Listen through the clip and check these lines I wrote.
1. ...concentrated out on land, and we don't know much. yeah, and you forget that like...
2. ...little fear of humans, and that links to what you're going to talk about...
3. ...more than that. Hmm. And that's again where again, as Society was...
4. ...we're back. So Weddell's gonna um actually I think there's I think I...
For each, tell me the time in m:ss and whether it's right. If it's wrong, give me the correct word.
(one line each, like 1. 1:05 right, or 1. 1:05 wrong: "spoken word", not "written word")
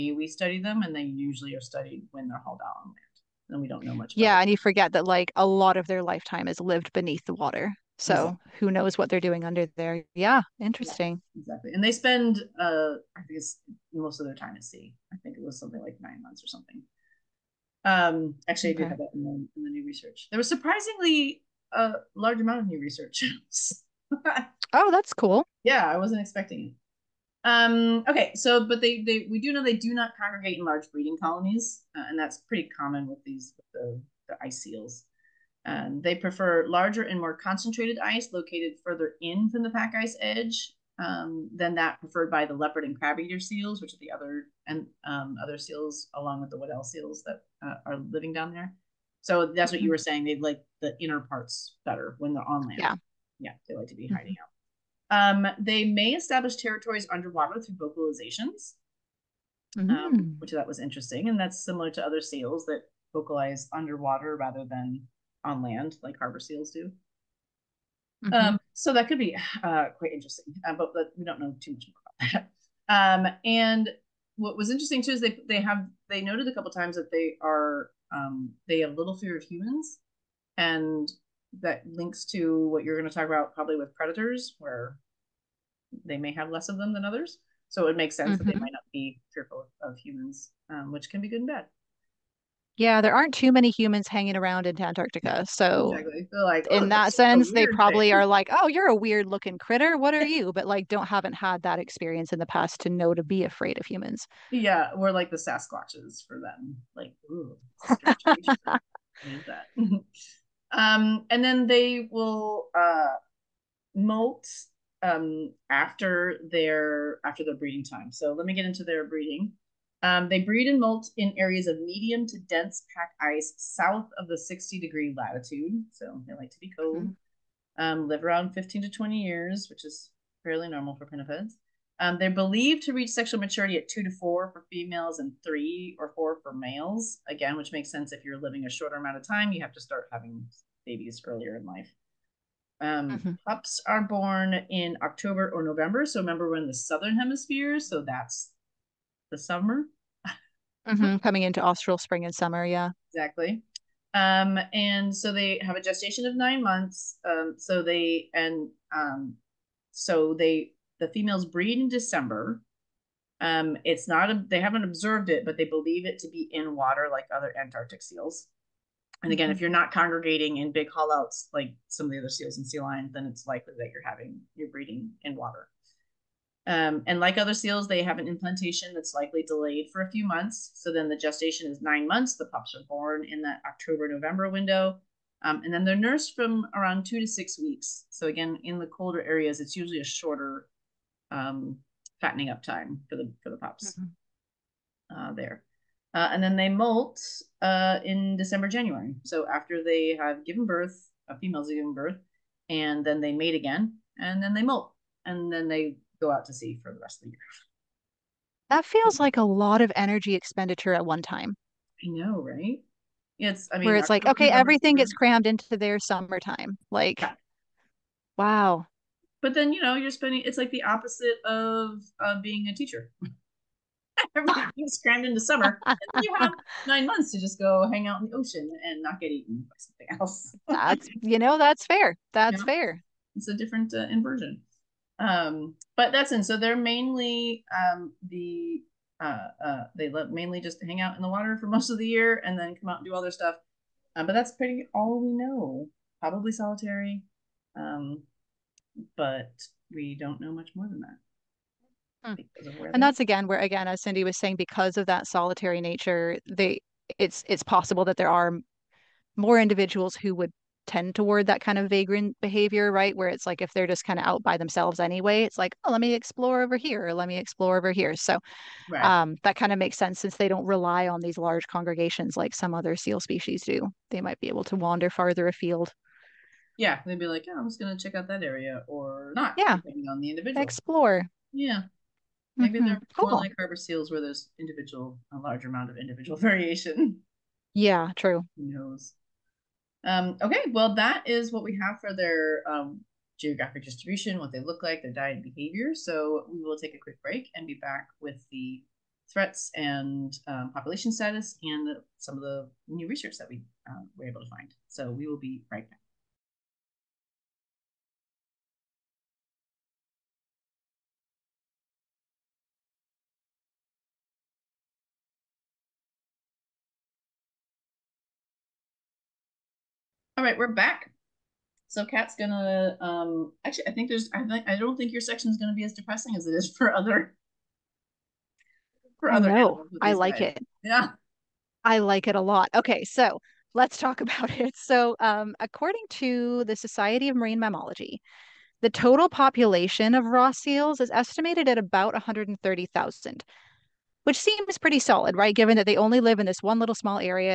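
1. 0:02 wrong: "hauled", not "concentrated"
2. 1:18 right
3. 4:10 wrong: "Cindy", not "Society"
4. 5:20 wrong: "Kat", not "Weddell".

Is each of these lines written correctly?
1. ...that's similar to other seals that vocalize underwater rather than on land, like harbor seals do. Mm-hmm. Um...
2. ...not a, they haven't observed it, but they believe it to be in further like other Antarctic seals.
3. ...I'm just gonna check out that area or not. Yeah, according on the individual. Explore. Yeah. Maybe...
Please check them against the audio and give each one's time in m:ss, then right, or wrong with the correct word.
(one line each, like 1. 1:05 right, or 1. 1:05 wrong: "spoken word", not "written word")
1. 1:01 right
2. 2:44 wrong: "water", not "further"
3. 4:37 wrong: "depending", not "according".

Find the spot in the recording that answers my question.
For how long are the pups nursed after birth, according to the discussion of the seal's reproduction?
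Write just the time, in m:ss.
3:07.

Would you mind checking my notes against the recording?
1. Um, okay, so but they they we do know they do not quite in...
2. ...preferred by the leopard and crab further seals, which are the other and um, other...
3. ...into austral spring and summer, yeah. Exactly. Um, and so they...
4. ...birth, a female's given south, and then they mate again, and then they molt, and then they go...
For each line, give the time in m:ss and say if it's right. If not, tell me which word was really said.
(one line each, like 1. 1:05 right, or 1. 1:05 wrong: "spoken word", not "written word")
1. 0:27 wrong: "congregate", not "quite"
2. 0:41 wrong: "eater", not "further"
3. 2:31 right
4. 3:20 wrong: "birth", not "south".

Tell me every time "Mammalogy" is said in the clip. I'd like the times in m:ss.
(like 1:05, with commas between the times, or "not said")
5:37.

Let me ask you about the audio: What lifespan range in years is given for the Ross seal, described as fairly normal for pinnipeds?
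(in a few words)
15 to 20 years.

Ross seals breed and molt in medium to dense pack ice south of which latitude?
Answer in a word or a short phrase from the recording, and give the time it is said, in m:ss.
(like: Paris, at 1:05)
60 degrees, at 2:04.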